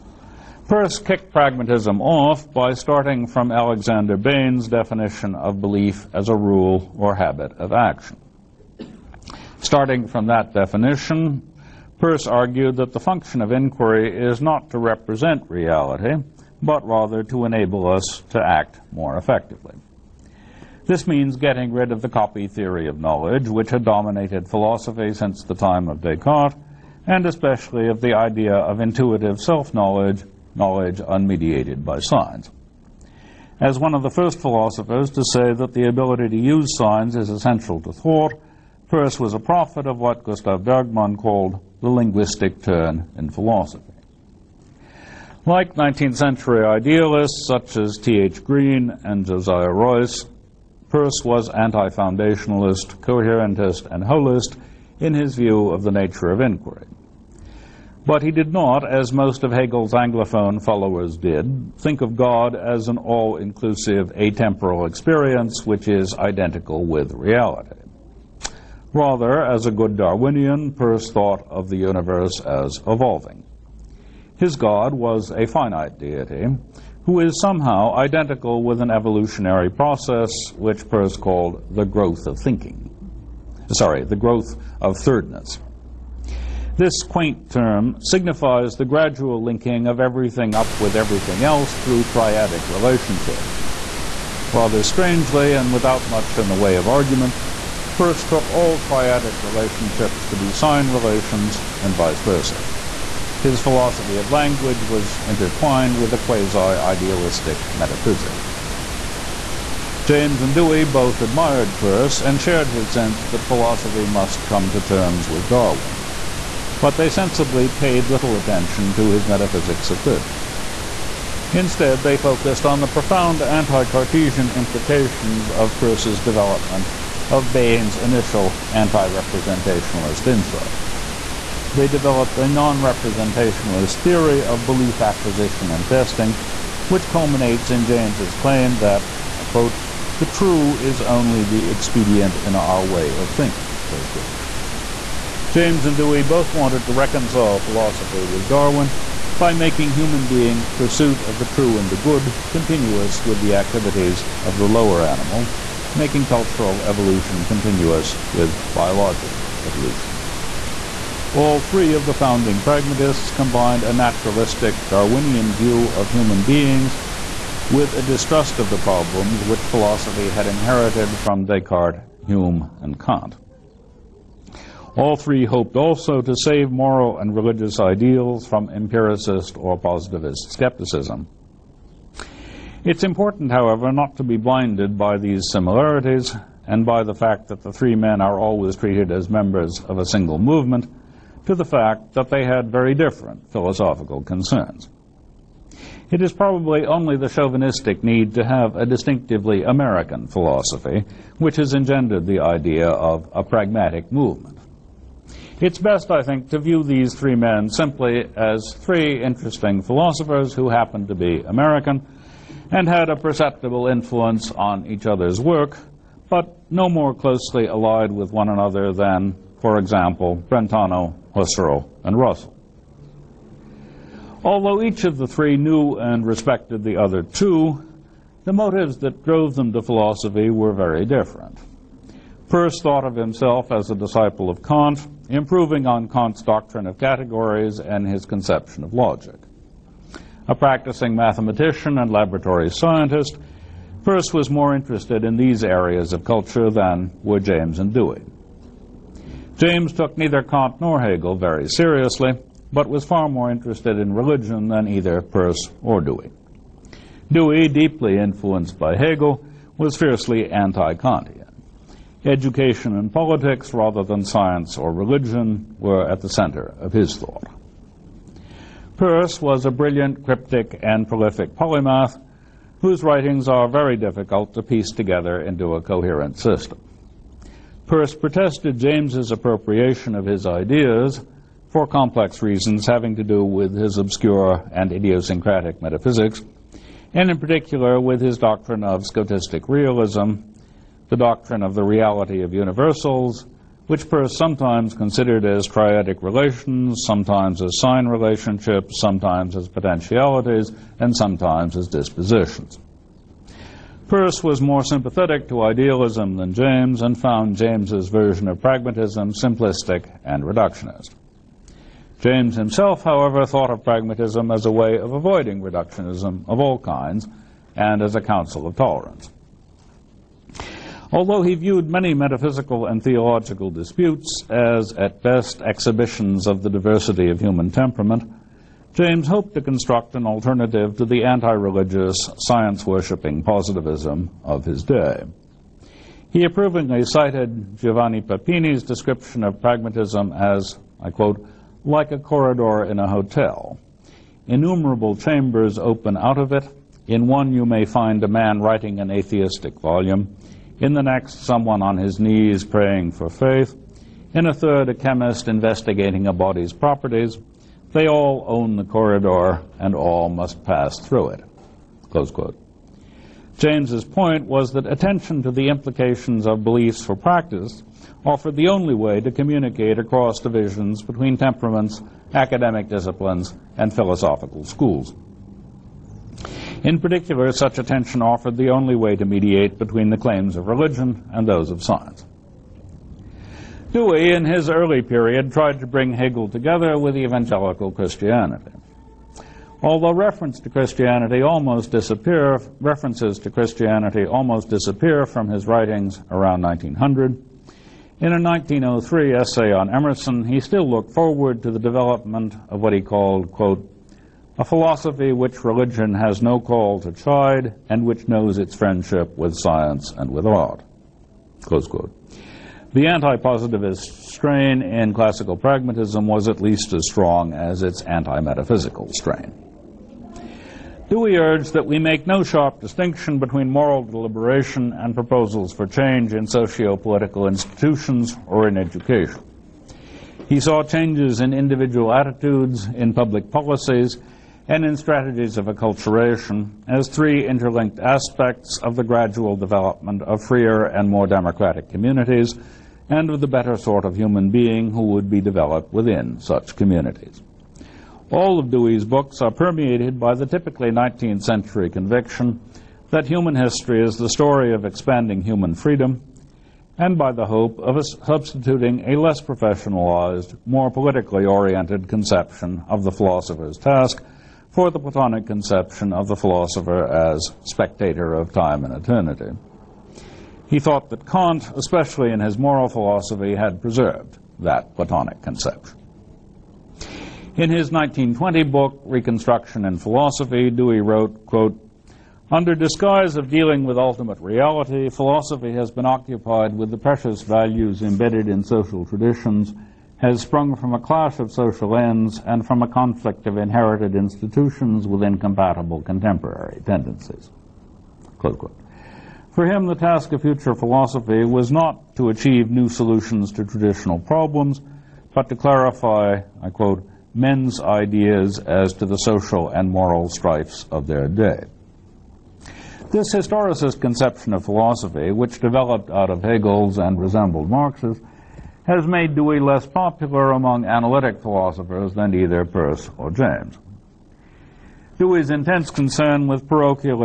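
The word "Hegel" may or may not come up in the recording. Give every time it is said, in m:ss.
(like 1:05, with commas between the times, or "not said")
0:59, 4:11, 4:18, 6:26, 8:36.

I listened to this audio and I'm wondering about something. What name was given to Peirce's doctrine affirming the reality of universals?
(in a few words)
scotistic realism.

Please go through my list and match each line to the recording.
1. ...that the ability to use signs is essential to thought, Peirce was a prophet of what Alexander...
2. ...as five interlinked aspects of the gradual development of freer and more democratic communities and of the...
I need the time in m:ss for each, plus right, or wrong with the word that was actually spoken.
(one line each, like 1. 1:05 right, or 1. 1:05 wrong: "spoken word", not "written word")
1. 0:35 wrong: "Gustav", not "Alexander"
2. 7:16 wrong: "three", not "five".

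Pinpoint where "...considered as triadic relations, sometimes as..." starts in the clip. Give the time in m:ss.
4:54.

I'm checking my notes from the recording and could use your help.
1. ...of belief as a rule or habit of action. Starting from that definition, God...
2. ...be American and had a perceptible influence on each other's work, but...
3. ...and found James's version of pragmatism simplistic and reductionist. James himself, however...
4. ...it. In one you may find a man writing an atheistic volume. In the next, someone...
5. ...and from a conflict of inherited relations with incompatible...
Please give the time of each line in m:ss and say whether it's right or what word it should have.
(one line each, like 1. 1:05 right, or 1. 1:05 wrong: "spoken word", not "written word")
1. 0:05 wrong: "Peirce", not "God"
2. 3:31 right
3. 5:07 right
4. 5:46 right
5. 8:12 wrong: "institutions", not "relations".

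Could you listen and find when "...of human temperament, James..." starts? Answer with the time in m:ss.
5:27.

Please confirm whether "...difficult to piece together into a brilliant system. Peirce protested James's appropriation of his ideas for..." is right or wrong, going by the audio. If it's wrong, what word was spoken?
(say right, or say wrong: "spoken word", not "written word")
wrong: "coherent", not "brilliant".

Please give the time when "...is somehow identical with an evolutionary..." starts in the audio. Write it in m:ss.
1:17.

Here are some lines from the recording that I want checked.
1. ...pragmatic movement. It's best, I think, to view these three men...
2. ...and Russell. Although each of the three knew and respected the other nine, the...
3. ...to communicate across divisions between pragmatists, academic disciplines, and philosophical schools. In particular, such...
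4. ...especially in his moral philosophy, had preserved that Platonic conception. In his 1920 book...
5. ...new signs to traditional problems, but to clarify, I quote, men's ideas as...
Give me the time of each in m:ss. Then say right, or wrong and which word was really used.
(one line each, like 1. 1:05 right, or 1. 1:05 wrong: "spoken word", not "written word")
1. 3:23 right
2. 3:42 wrong: "two", not "nine"
3. 6:09 wrong: "temperaments", not "pragmatists"
4. 7:51 right
5. 8:22 wrong: "solutions", not "signs".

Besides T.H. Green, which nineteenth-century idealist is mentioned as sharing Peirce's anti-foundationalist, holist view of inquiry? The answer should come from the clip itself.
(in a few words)
Josiah Royce.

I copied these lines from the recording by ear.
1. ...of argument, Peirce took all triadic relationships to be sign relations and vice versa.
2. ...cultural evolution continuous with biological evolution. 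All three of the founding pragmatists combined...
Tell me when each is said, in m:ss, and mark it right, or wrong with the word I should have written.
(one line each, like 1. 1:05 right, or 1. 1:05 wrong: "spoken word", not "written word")
1. 1:36 right
2. 2:36 right.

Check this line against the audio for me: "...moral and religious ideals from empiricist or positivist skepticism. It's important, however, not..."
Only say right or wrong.
right.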